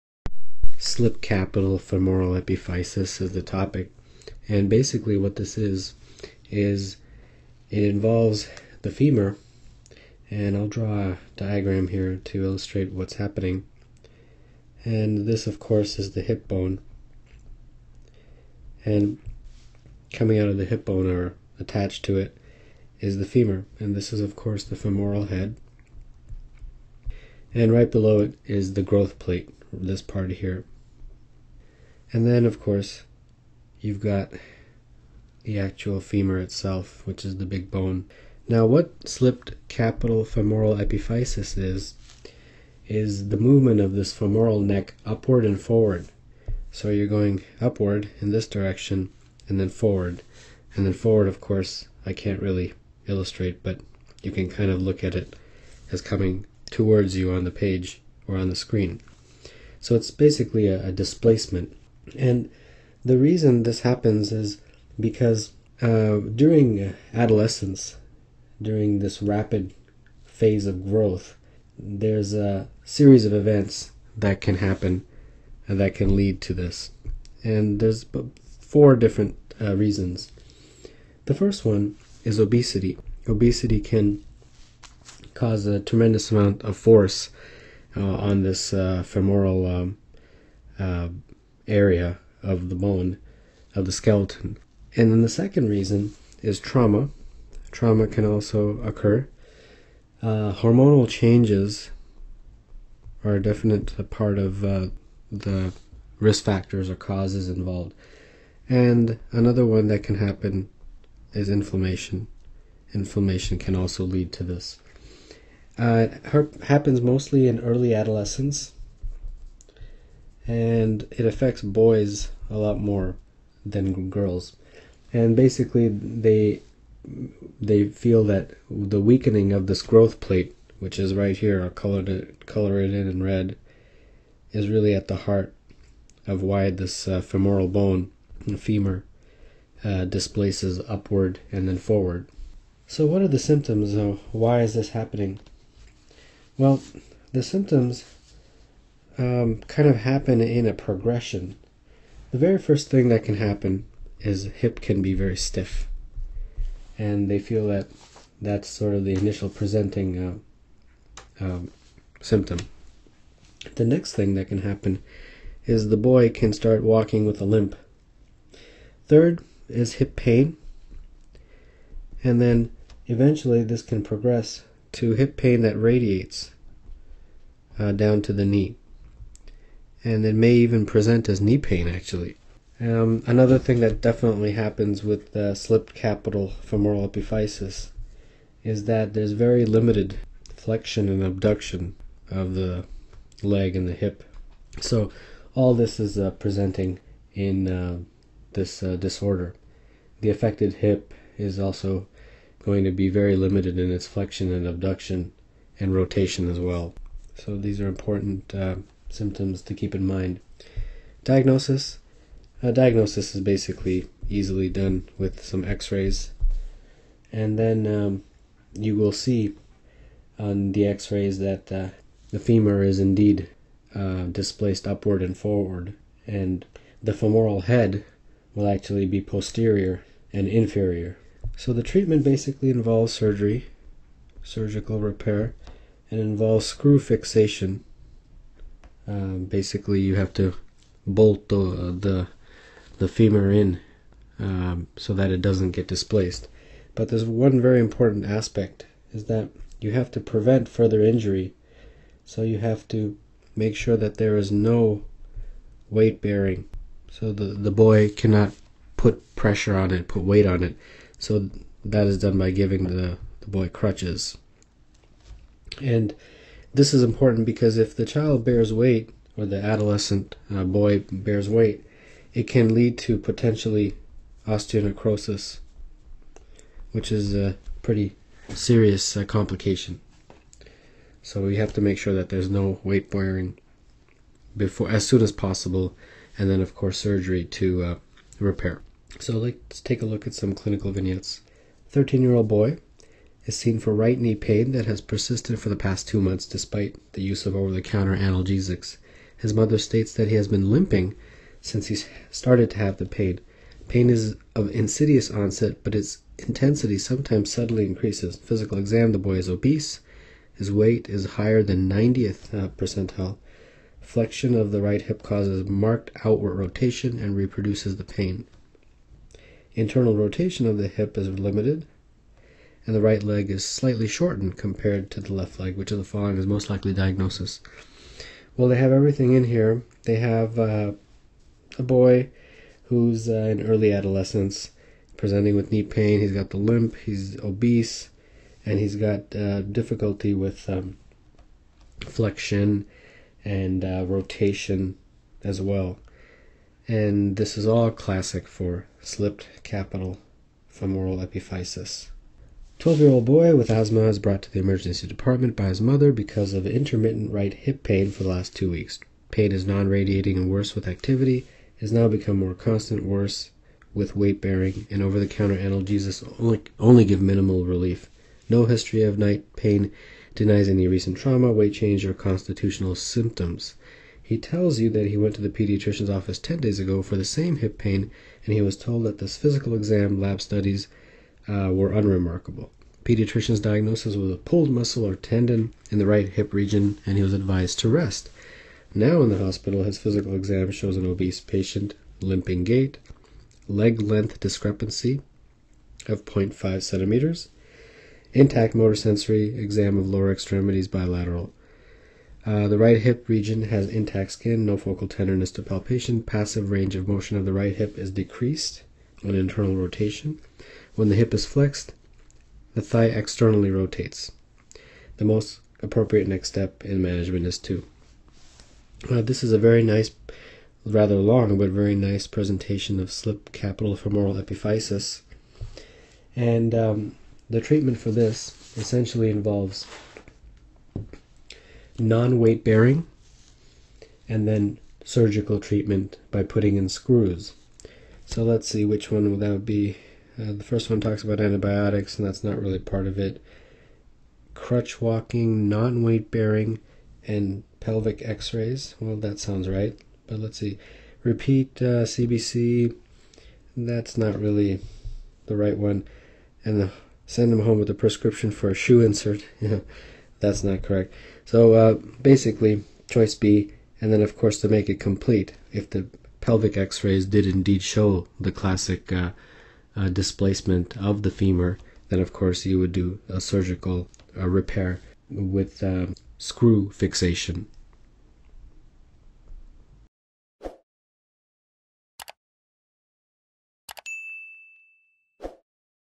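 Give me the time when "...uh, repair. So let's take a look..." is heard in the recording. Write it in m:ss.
4:47.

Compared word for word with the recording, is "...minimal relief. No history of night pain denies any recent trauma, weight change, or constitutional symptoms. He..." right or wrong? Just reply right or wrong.
right.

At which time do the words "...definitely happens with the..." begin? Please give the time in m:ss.
3:04.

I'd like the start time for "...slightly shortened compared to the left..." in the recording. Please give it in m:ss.
5:23.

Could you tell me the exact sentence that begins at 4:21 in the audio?
So that is done by giving the, the boy crutches.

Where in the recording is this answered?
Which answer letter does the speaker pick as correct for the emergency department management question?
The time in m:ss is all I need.
7:43.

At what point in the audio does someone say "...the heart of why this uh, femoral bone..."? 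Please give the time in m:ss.
2:15.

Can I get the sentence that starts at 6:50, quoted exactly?
When the hip is flexed, the thigh externally rotates.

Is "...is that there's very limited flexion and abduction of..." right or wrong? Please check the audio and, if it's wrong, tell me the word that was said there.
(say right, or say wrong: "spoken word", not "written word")
right.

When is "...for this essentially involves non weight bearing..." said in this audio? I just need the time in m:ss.
7:07.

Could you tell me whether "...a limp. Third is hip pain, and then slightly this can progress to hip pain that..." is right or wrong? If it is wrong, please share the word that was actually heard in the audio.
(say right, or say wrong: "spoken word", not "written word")
wrong: "eventually", not "slightly".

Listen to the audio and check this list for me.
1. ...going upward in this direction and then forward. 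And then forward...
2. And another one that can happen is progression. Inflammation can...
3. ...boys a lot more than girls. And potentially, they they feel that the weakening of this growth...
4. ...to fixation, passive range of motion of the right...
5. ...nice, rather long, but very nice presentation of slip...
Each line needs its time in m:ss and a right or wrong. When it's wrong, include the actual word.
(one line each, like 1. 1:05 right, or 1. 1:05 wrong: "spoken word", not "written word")
1. 0:47 right
2. 1:48 wrong: "inflammation", not "progression"
3. 2:01 wrong: "basically", not "potentially"
4. 6:45 wrong: "palpation", not "fixation"
5. 6:59 right.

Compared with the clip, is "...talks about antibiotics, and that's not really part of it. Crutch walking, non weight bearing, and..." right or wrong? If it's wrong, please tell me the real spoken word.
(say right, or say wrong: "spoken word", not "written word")
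right.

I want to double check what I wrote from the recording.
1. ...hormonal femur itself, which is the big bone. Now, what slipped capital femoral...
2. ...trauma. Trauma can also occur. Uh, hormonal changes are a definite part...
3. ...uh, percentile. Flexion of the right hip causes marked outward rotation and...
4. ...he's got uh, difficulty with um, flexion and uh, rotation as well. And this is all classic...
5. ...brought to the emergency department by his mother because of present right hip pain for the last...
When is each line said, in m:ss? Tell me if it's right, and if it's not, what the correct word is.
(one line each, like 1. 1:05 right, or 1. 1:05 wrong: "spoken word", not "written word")
1. 0:35 wrong: "actual", not "hormonal"
2. 1:36 right
3. 5:12 right
4. 5:38 right
5. 5:54 wrong: "intermittent", not "present".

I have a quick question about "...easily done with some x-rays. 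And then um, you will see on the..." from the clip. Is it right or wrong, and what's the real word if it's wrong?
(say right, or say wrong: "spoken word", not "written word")
right.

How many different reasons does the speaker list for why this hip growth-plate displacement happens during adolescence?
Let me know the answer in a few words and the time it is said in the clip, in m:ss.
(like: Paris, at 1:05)
4, at 1:18.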